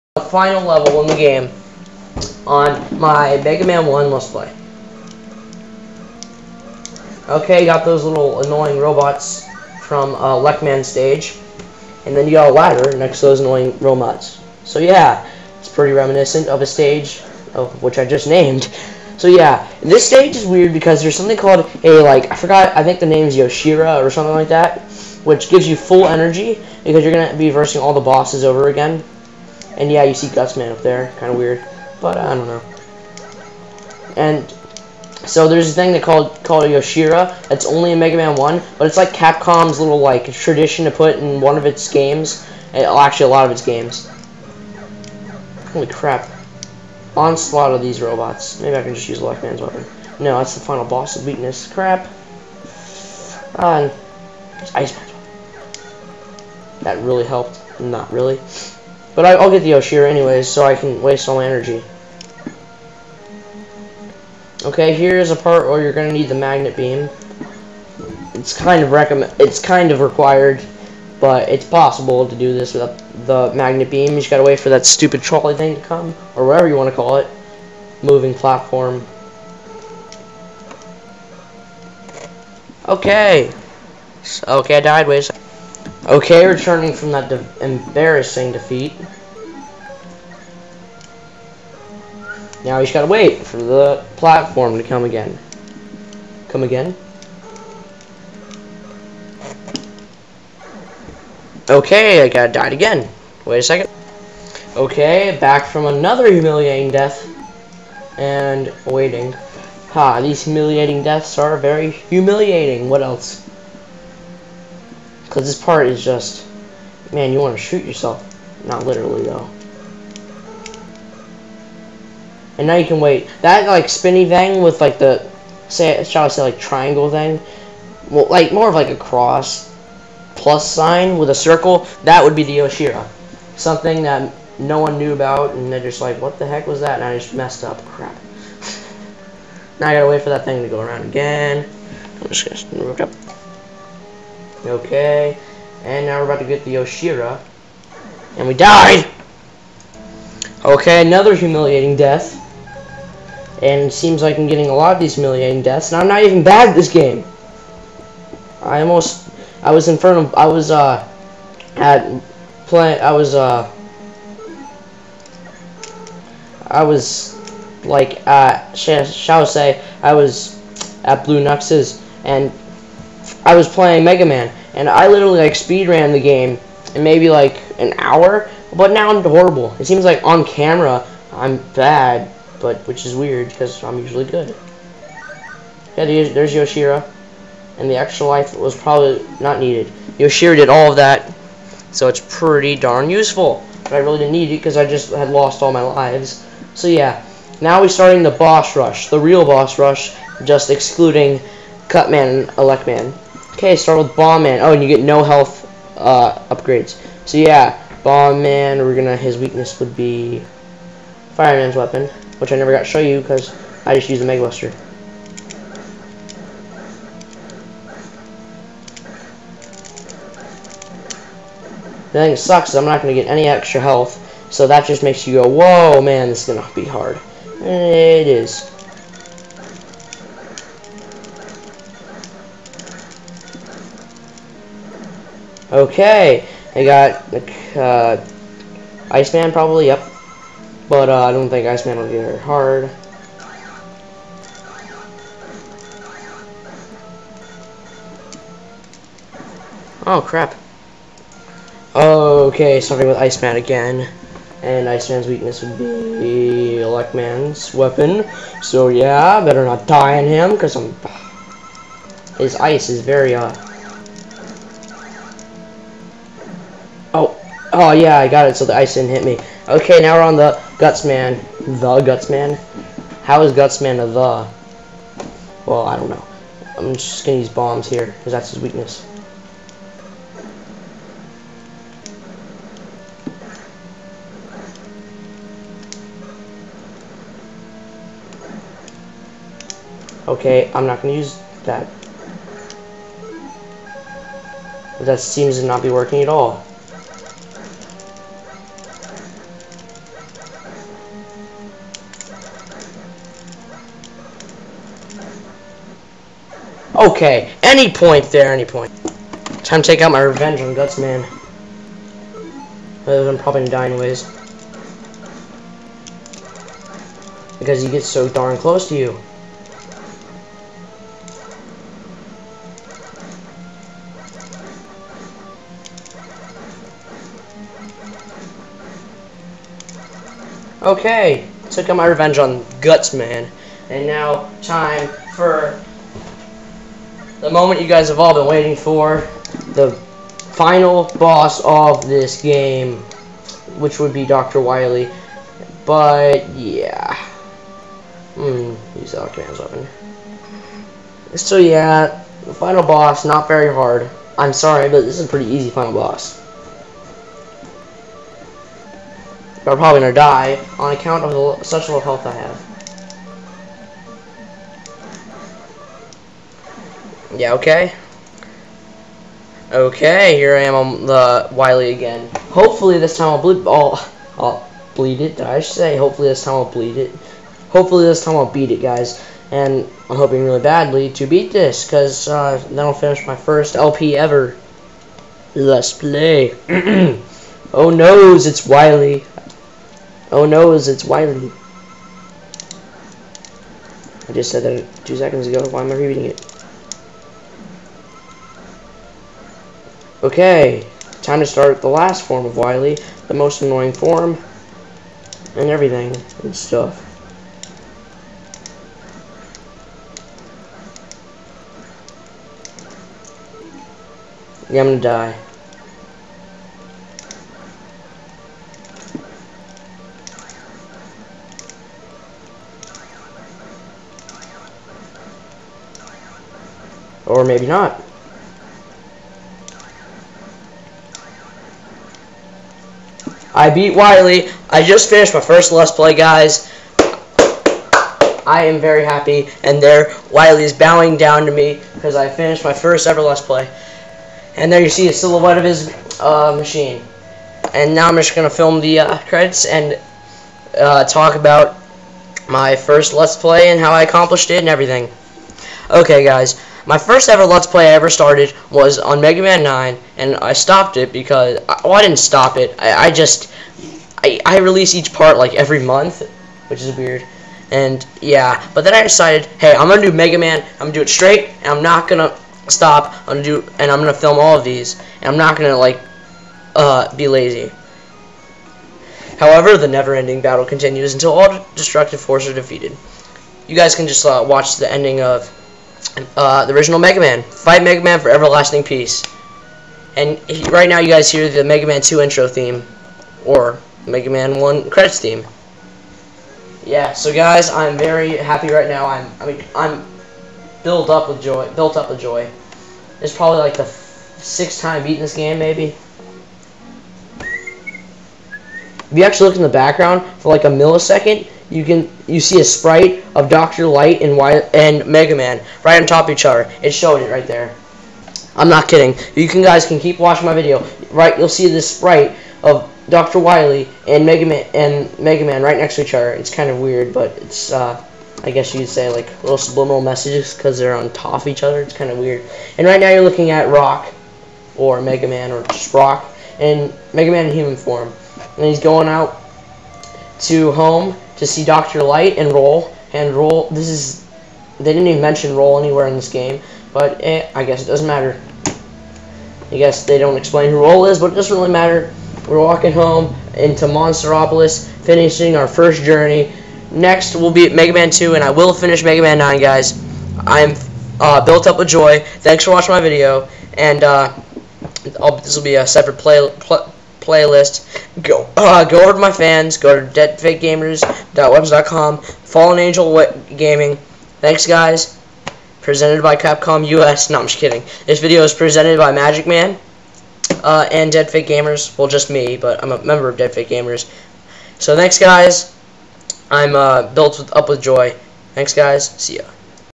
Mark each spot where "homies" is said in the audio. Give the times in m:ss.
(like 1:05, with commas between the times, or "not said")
not said.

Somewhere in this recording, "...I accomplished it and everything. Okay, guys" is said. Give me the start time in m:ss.
7:33.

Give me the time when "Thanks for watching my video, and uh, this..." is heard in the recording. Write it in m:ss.
9:22.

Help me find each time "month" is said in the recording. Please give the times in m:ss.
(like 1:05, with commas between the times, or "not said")
7:45.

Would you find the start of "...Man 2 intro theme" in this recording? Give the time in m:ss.
8:11.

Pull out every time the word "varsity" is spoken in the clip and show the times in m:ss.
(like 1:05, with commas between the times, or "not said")
not said.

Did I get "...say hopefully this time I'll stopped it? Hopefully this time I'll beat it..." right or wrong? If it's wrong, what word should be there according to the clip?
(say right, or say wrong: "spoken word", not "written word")
wrong: "bleed", not "stopped".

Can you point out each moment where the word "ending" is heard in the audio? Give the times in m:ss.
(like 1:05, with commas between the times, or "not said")
7:59, 8:04.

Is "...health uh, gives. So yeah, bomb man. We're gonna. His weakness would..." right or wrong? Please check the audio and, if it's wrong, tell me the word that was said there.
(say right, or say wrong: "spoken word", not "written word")
wrong: "upgrades", not "gives".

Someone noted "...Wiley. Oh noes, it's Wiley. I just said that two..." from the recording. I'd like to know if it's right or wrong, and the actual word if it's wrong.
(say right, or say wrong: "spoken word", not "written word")
right.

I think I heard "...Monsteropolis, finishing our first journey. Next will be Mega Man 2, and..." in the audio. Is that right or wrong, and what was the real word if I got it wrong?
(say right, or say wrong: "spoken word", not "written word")
right.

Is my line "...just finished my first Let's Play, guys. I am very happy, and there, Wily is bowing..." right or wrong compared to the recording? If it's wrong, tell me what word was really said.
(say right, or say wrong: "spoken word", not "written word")
right.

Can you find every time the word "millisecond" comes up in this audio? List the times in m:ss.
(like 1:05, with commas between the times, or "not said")
8:30.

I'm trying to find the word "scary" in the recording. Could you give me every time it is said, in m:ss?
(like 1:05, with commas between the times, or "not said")
not said.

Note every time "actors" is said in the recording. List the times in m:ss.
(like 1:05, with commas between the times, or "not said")
not said.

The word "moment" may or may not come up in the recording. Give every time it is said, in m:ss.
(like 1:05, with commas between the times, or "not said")
5:37.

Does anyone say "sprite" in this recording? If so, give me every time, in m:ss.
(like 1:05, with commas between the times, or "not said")
8:32, 8:41.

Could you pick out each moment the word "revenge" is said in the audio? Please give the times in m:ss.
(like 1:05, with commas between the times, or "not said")
5:10, 5:32.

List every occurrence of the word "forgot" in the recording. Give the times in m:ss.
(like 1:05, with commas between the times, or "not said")
0:22.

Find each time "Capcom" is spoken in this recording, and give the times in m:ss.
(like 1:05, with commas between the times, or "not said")
0:39, 9:36.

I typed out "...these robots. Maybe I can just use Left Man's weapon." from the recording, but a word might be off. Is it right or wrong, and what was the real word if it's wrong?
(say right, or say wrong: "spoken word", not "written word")
right.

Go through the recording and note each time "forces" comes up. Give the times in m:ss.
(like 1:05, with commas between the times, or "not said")
8:02.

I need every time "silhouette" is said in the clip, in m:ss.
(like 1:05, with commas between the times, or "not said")
7:25.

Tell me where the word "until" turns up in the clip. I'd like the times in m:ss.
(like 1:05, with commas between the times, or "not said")
8:01.